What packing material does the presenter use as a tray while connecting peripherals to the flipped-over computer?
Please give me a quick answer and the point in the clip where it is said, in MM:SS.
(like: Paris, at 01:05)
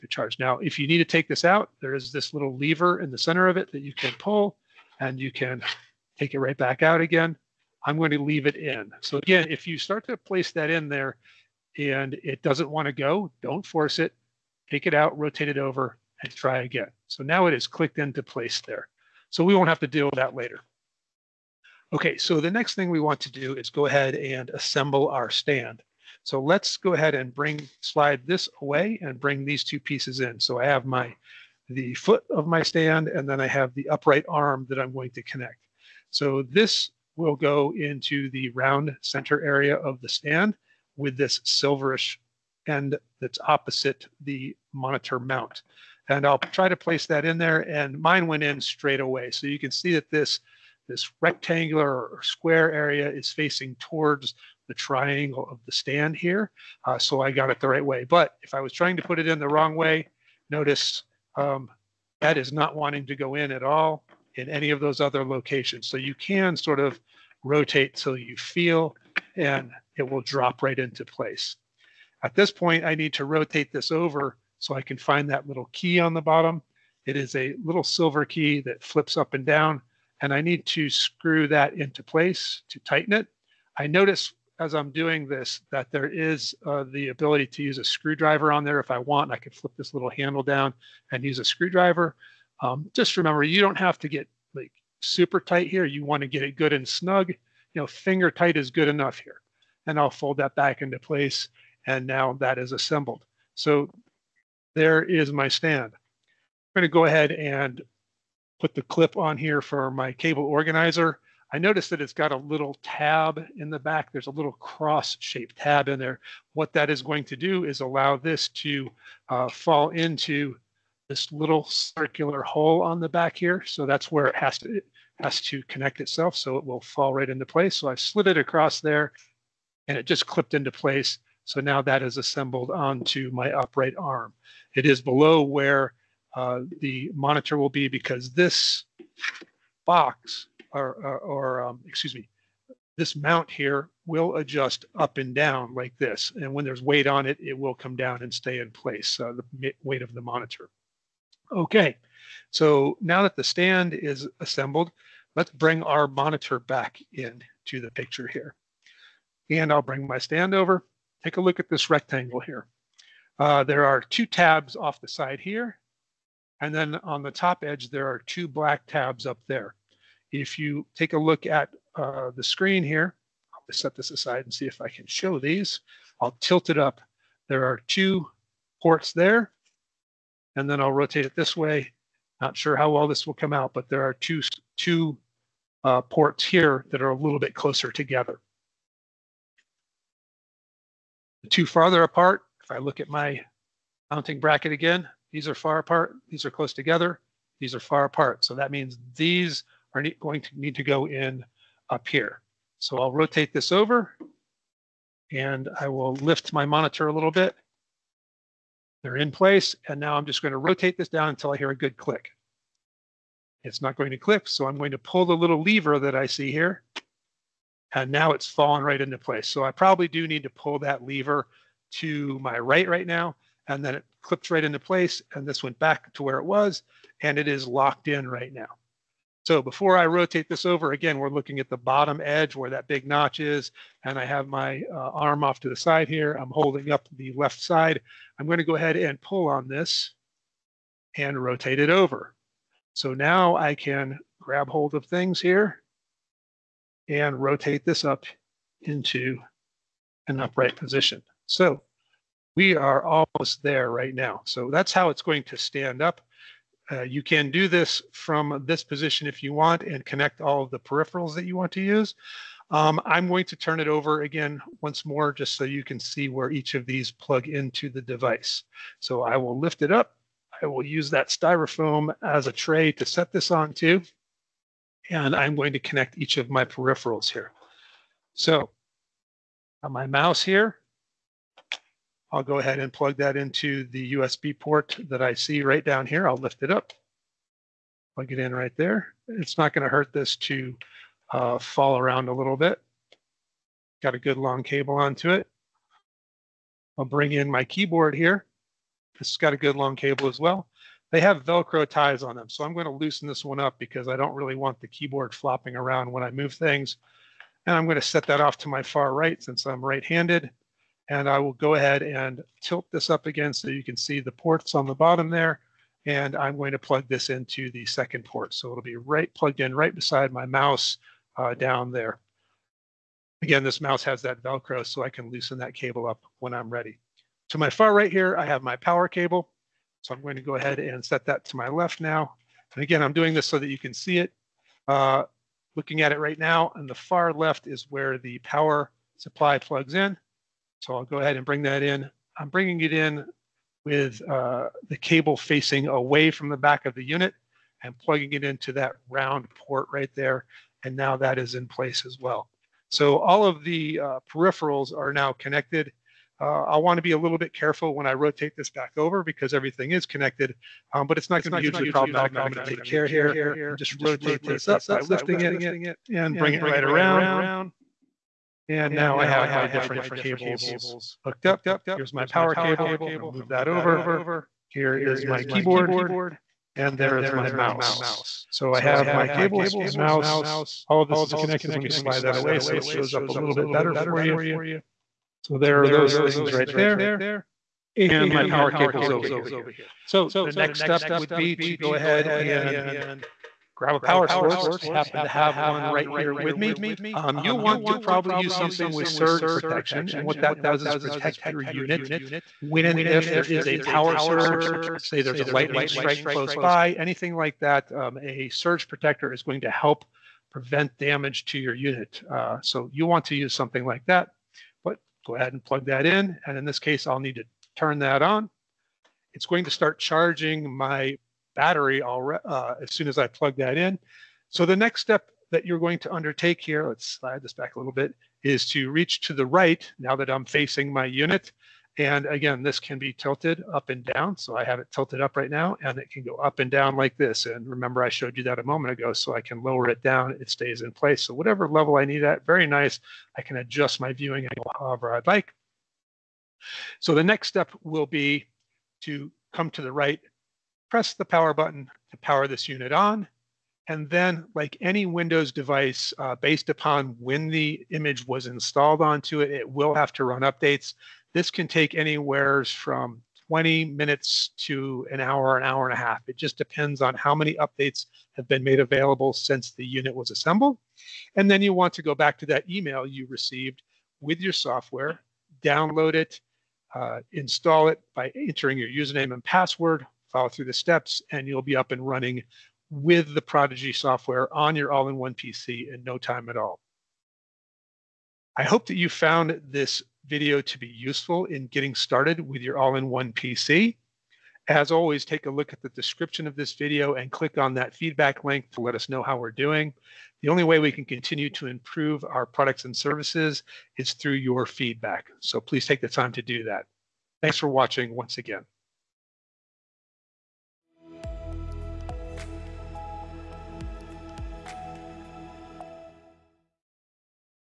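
Styrofoam, at 04:31.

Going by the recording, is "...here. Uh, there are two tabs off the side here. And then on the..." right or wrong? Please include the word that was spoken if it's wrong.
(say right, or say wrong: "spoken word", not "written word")
right.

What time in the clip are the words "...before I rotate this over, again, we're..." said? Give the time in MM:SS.
03:49.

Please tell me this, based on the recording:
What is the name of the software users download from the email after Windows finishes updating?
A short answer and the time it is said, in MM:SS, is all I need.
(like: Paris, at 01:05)
Prodigi, at 08:03.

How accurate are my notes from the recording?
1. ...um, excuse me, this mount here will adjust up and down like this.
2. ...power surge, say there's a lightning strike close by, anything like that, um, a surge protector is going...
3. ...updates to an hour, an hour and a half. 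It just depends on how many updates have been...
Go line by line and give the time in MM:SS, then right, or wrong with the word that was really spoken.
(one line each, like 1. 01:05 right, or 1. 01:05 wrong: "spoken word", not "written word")
1. 02:21 right
2. 06:43 right
3. 07:43 wrong: "minutes", not "updates".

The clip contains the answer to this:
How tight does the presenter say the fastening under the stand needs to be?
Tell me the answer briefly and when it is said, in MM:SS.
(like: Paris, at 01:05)
Finger tight, at 01:37.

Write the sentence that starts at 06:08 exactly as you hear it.
And now I have my different cables hooked up.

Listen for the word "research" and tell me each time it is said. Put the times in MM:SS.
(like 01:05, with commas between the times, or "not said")
not said.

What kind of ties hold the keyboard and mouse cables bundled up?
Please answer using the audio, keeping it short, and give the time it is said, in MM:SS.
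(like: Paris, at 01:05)
Velcro ties, at 05:01.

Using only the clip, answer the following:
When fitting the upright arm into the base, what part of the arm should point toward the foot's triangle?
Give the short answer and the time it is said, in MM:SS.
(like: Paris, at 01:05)
Rectangular or square area, at 00:51.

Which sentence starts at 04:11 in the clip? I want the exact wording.
So we are almost there right now.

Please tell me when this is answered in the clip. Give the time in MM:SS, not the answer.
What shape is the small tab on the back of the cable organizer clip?
01:54.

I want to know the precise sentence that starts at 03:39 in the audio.
So I probably do need to pull that lever to my right right now.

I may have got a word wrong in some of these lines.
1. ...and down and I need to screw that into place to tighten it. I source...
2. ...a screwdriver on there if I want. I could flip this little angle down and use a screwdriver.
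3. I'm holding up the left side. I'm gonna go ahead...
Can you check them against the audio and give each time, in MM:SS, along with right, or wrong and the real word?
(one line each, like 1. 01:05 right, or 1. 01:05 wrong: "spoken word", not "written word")
1. 01:19 wrong: "notice", not "source"
2. 01:27 wrong: "handle", not "angle"
3. 03:56 right.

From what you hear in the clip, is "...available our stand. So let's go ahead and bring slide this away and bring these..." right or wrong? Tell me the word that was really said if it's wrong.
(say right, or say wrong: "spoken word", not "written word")
wrong: "assemble", not "available".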